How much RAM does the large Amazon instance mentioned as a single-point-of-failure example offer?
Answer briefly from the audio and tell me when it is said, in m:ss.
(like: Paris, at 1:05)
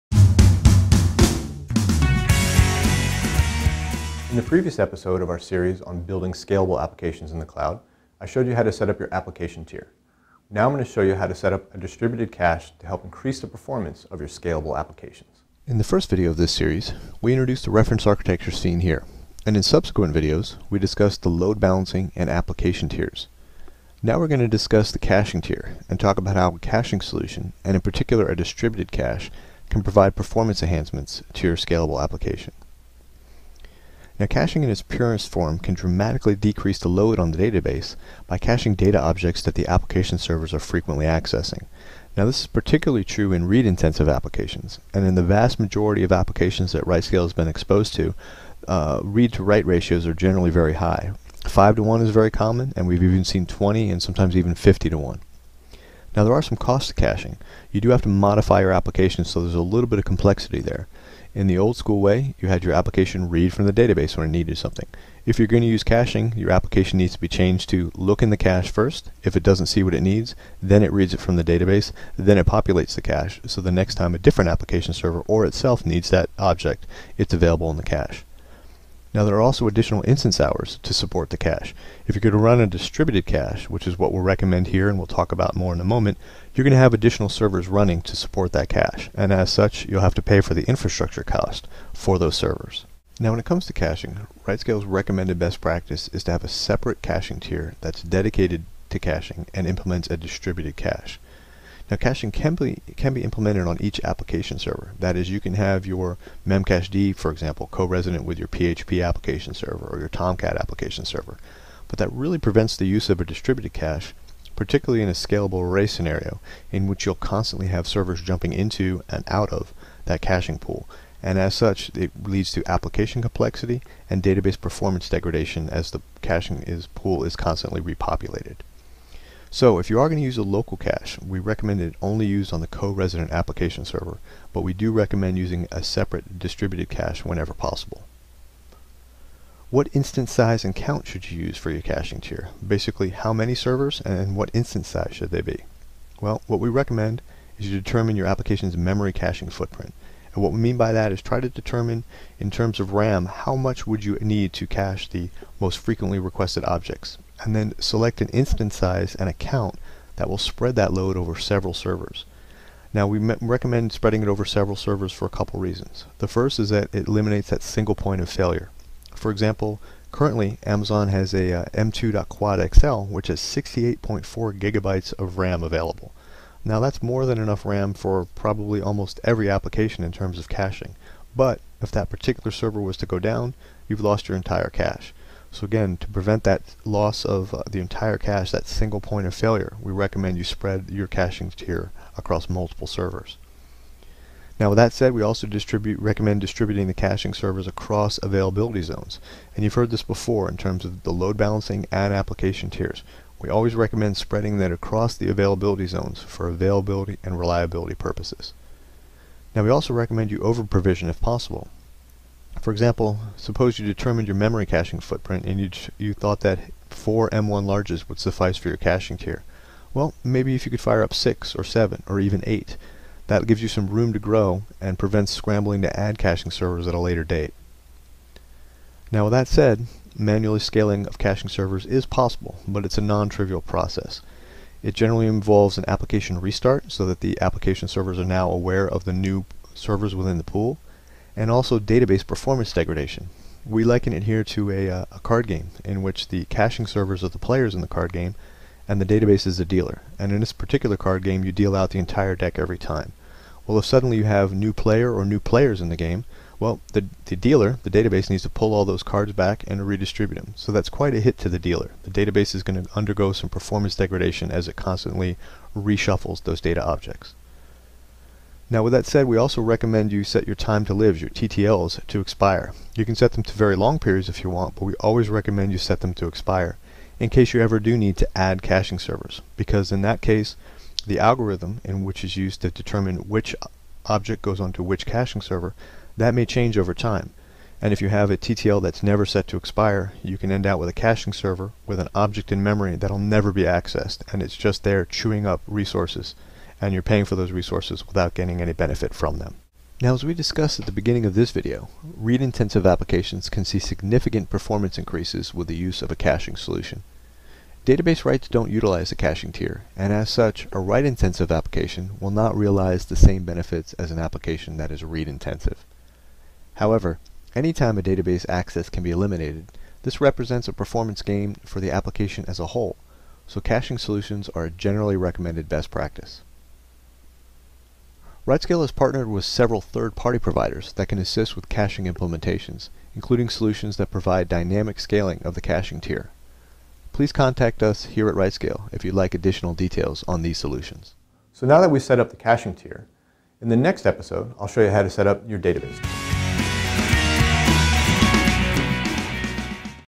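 68.4 gigabytes, at 2:53.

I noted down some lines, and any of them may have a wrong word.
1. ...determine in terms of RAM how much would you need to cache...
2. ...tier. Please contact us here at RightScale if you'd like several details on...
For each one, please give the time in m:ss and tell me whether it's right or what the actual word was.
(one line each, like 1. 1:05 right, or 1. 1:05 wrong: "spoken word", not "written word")
1. 2:31 right
2. 5:36 wrong: "additional", not "several".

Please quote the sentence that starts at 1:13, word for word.
So the next time a different application server or itself needs that object, it's available in the cache.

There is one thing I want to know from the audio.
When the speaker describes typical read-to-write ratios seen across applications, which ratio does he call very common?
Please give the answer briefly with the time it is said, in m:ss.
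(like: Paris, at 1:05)
5 to 1, at 0:51.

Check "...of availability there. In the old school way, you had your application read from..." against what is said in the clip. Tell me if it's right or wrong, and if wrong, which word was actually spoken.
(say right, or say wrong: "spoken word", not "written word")
wrong: "complexity", not "availability".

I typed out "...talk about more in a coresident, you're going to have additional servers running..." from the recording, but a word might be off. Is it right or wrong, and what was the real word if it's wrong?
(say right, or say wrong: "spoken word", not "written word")
wrong: "moment", not "coresident".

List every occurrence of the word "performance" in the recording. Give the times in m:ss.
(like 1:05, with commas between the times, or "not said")
0:13, 0:30, 2:04, 4:02, 4:23, 5:04, 5:20.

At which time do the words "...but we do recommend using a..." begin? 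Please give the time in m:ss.
2:14.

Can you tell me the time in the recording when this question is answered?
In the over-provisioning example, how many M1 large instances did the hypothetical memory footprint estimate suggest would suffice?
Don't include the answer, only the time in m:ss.
3:36.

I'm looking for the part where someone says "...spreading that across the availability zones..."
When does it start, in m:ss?
3:24.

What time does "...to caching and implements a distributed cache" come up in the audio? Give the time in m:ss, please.
1:38.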